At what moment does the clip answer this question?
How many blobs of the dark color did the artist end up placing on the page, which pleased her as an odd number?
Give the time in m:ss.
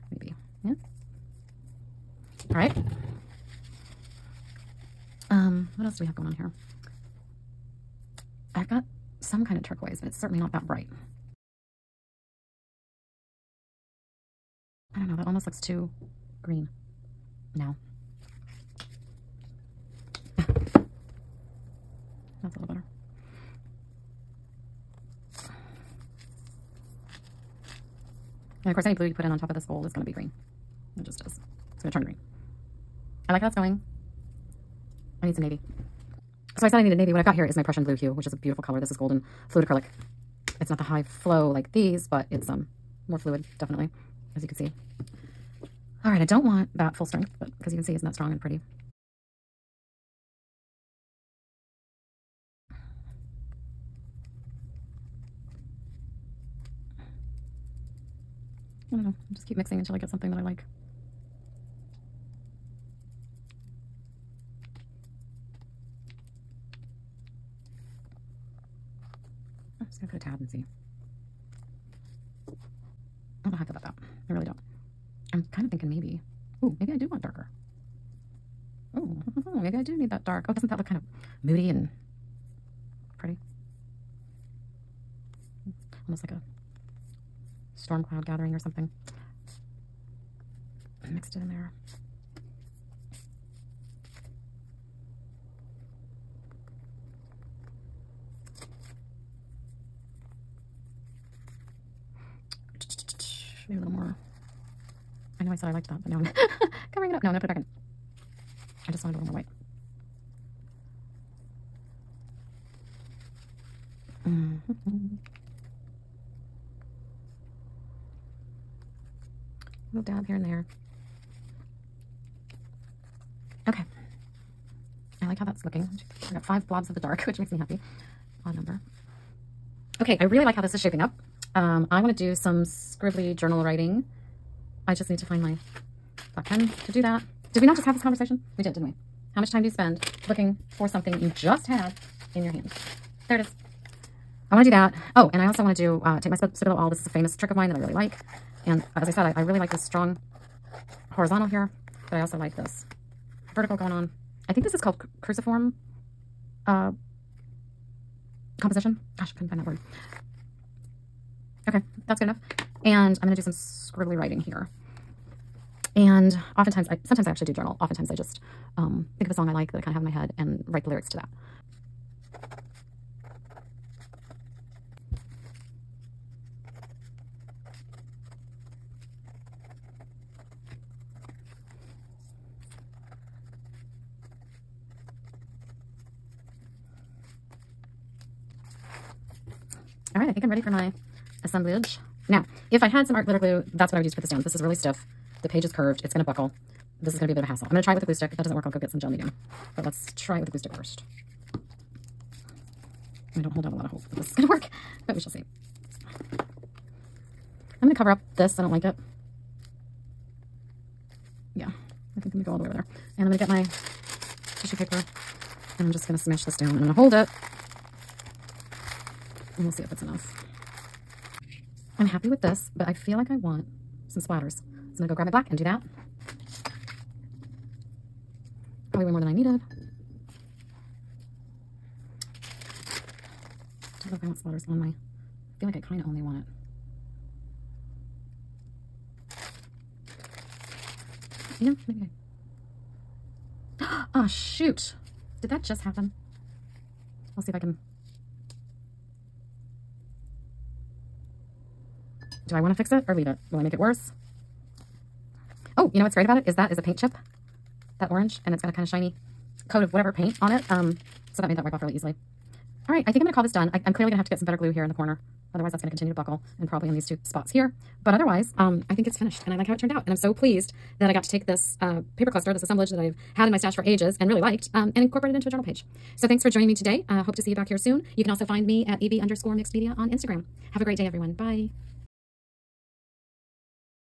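2:06.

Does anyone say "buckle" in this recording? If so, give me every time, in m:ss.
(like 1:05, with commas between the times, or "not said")
3:16, 4:26.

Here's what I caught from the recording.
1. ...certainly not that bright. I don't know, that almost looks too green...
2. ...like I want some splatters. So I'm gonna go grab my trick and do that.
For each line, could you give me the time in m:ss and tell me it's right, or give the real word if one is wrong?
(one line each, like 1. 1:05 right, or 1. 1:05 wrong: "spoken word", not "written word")
1. 0:10 right
2. 3:43 wrong: "black", not "trick".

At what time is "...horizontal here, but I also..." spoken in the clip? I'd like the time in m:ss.
2:31.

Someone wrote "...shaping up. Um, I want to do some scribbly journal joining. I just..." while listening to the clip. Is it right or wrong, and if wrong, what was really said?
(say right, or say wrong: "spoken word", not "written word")
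wrong: "writing", not "joining".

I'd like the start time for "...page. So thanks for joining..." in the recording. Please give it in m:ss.
4:35.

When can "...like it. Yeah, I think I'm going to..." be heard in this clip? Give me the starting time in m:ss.
3:28.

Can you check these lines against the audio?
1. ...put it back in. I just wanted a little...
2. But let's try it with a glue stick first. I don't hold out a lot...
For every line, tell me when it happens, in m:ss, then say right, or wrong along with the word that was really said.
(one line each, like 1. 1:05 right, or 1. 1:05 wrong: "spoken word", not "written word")
1. 1:47 right
2. 3:19 right.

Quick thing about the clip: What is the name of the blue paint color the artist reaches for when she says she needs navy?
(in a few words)
Prussian blue hue.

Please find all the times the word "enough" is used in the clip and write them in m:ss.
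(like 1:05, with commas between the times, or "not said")
2:42, 3:40.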